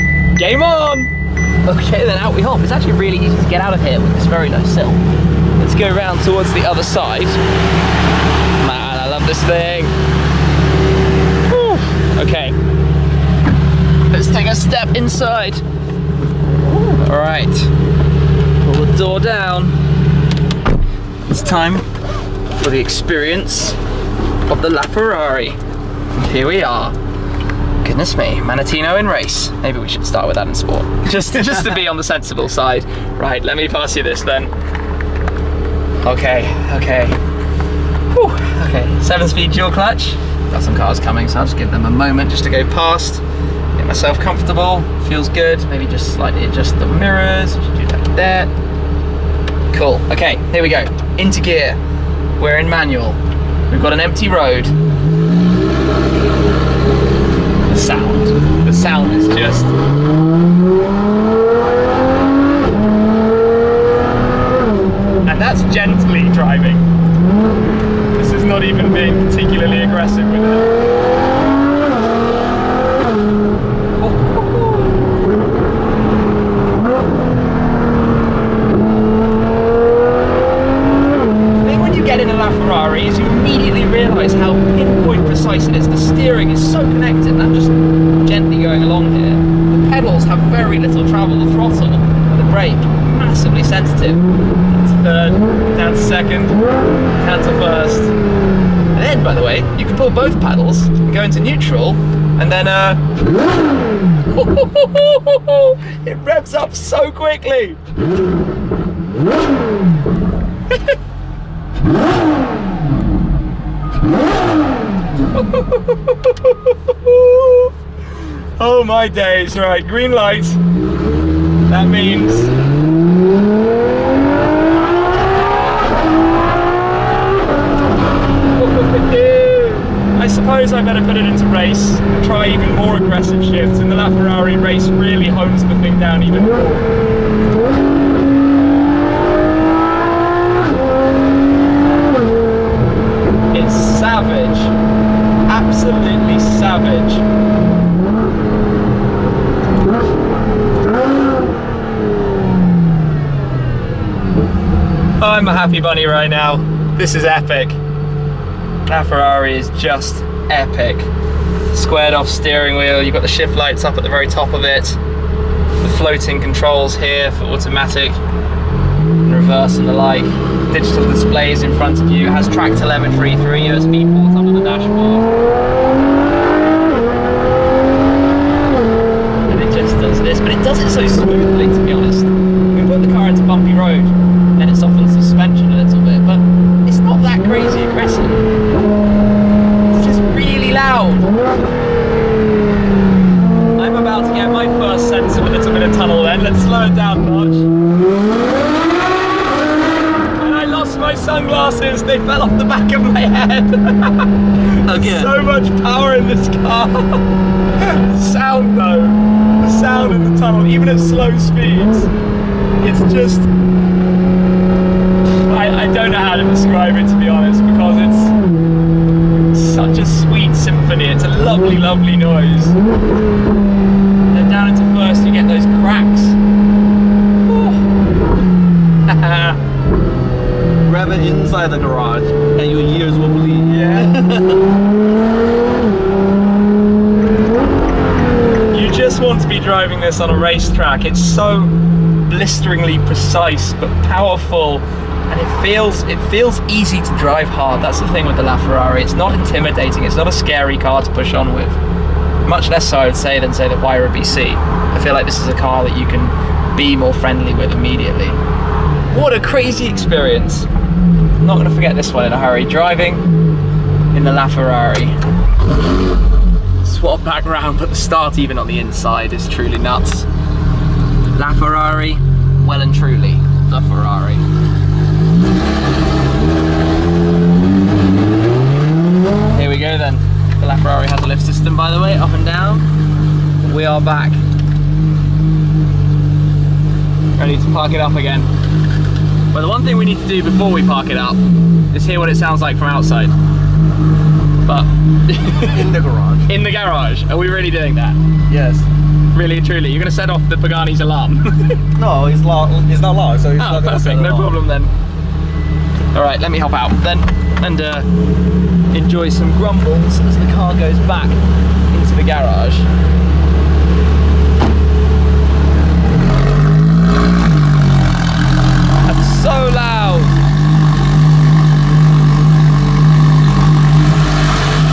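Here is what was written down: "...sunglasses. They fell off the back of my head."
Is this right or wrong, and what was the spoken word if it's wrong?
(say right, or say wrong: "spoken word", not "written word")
right.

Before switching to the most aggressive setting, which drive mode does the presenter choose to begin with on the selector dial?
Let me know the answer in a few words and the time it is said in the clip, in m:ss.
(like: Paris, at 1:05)
Sport, at 0:30.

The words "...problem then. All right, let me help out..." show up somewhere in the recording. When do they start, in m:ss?
5:04.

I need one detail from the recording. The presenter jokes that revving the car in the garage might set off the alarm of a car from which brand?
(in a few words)
Pagani.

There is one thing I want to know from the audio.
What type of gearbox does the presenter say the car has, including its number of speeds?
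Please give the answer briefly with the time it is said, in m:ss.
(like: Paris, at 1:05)
Seven speed dual clutch, at 0:39.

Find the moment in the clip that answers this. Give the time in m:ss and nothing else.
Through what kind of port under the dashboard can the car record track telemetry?
2:53.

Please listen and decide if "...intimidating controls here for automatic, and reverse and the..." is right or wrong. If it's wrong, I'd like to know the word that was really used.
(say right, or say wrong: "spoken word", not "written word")
wrong: "floating", not "intimidating".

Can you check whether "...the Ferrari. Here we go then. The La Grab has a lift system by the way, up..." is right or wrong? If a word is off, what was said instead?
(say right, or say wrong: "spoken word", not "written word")
wrong: "Ferrari", not "Grab".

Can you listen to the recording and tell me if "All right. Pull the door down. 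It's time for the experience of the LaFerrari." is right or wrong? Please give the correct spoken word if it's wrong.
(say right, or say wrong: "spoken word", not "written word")
right.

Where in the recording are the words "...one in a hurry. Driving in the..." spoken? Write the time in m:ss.
4:22.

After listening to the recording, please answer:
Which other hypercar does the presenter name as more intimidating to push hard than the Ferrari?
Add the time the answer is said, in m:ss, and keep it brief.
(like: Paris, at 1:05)
Huayra BC, at 4:13.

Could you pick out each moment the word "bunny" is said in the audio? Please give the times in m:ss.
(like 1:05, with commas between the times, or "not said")
2:35.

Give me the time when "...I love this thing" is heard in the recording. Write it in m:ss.
0:08.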